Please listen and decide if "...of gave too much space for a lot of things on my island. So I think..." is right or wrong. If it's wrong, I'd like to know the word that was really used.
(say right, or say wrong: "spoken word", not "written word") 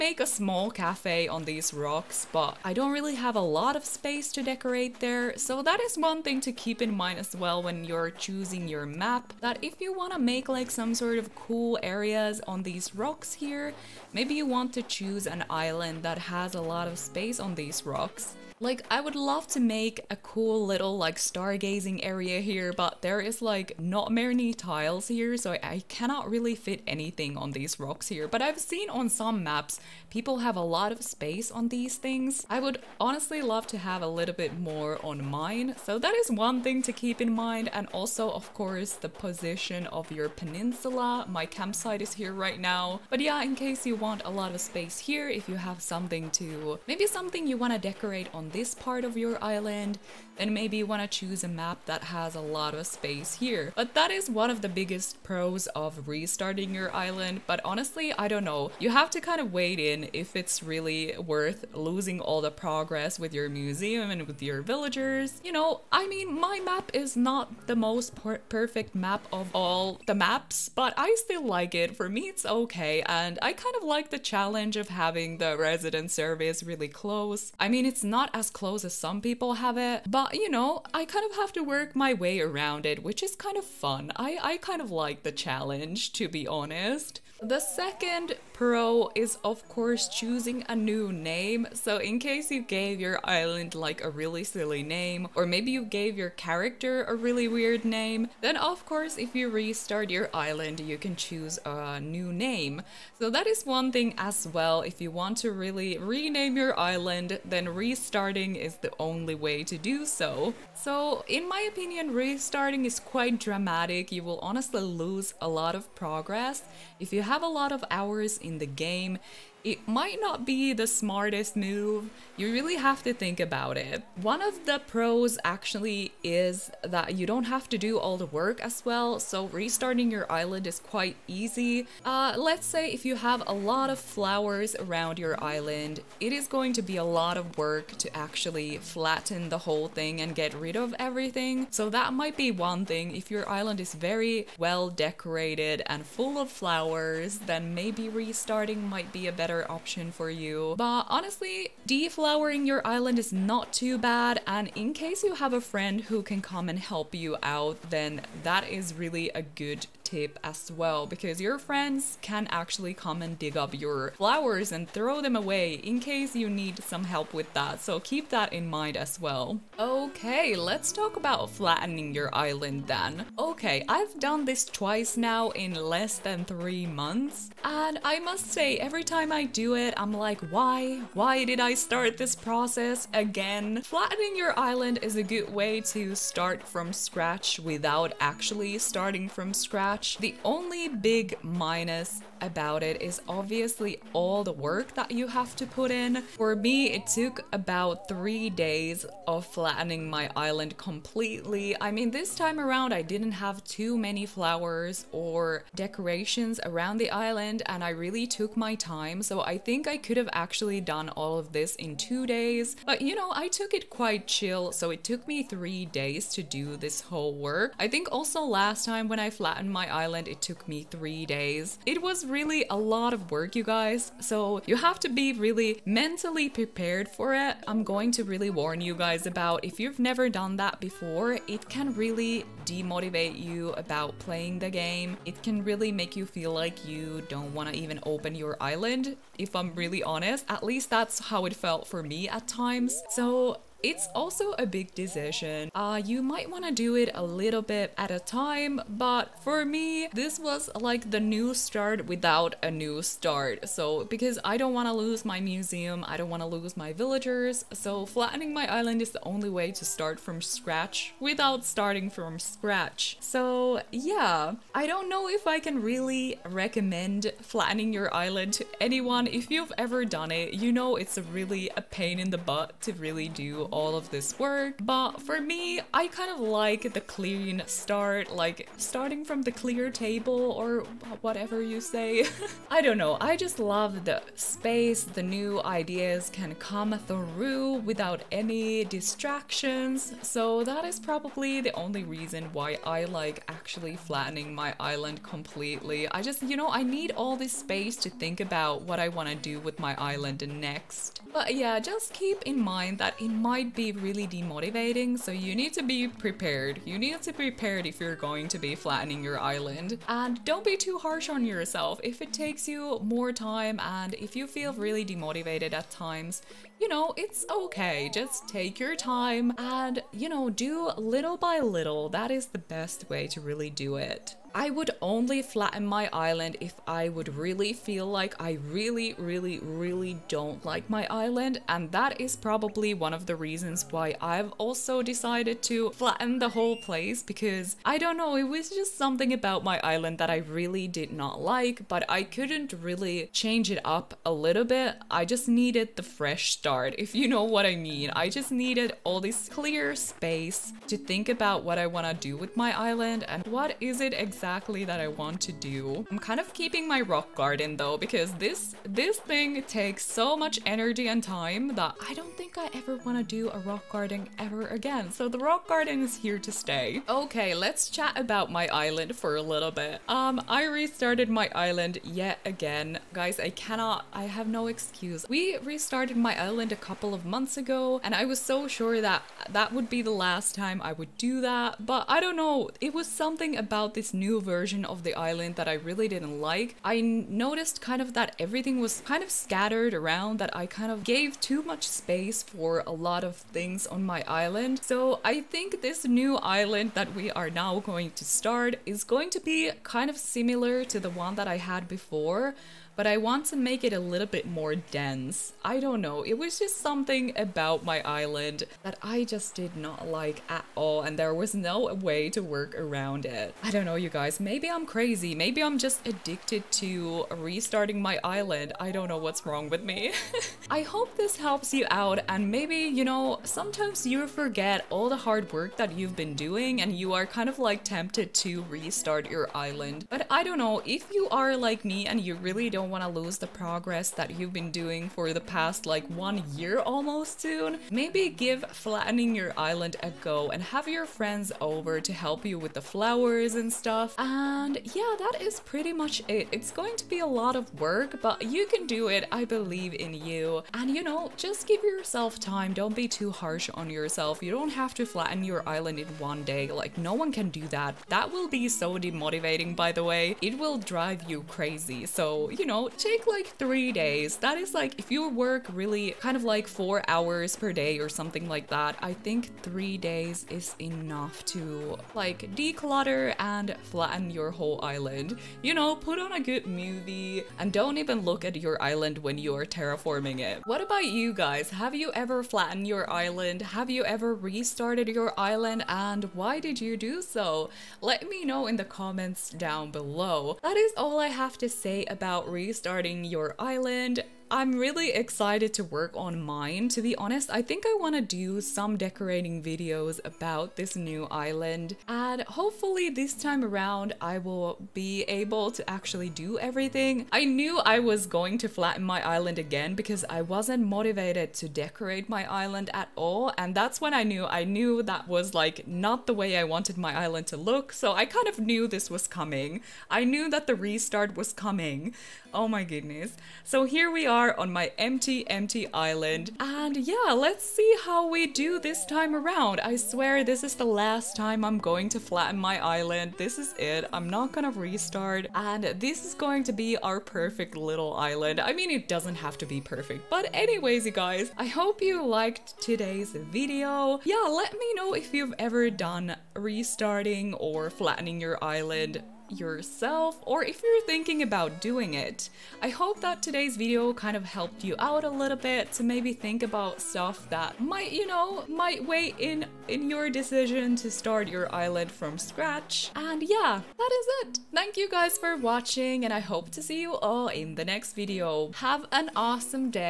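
right.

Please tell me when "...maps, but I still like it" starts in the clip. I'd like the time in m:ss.
1:10.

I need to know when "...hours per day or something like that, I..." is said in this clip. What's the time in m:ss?
7:47.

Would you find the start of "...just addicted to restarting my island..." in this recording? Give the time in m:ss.
6:55.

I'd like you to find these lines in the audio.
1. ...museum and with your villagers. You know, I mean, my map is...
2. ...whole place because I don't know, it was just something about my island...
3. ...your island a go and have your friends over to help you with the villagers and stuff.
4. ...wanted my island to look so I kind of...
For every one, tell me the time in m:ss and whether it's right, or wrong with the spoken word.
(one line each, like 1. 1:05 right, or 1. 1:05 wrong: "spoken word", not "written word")
1. 1:03 right
2. 5:36 right
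3. 7:19 wrong: "flowers", not "villagers"
4. 8:36 right.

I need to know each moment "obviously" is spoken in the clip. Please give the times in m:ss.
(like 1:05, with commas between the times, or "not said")
3:13.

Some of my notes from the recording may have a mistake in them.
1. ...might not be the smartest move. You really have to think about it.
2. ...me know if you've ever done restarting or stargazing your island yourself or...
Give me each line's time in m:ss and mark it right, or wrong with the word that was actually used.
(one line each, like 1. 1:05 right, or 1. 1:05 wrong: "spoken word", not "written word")
1. 1:59 right
2. 9:04 wrong: "flattening", not "stargazing".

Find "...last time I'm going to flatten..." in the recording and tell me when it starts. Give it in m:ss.
8:50.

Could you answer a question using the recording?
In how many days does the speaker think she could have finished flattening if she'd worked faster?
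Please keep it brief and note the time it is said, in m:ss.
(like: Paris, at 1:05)
2, at 3:31.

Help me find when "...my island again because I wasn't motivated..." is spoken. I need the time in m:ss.
8:29.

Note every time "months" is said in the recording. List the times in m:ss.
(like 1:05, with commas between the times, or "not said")
2:56, 6:17.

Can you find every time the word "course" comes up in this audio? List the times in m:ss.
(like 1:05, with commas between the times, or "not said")
0:38, 1:29, 1:38.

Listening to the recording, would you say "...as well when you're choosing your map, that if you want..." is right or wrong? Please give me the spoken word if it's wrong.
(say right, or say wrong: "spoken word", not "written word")
right.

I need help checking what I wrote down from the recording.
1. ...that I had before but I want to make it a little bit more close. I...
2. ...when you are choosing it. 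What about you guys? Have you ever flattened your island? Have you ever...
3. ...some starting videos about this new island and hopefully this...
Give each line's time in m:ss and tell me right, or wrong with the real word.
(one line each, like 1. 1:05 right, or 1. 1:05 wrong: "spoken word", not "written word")
1. 6:41 wrong: "dense", not "close"
2. 7:59 wrong: "terraforming", not "choosing"
3. 8:18 wrong: "decorating", not "starting".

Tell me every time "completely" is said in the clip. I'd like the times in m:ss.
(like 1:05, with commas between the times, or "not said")
3:20, 4:55.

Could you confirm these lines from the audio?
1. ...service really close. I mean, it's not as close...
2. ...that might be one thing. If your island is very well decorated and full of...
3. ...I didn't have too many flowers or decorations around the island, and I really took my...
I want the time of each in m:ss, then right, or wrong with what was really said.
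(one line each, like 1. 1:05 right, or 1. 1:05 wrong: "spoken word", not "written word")
1. 1:16 right
2. 2:21 right
3. 3:22 right.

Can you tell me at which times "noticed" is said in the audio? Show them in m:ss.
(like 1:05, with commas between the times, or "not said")
6:27.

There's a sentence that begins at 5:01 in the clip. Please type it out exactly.
But yeah, just keep in mind that in my might be really demotivating, so you need to be prepared.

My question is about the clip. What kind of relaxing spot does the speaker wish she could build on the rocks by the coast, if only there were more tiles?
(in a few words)
Stargazing area.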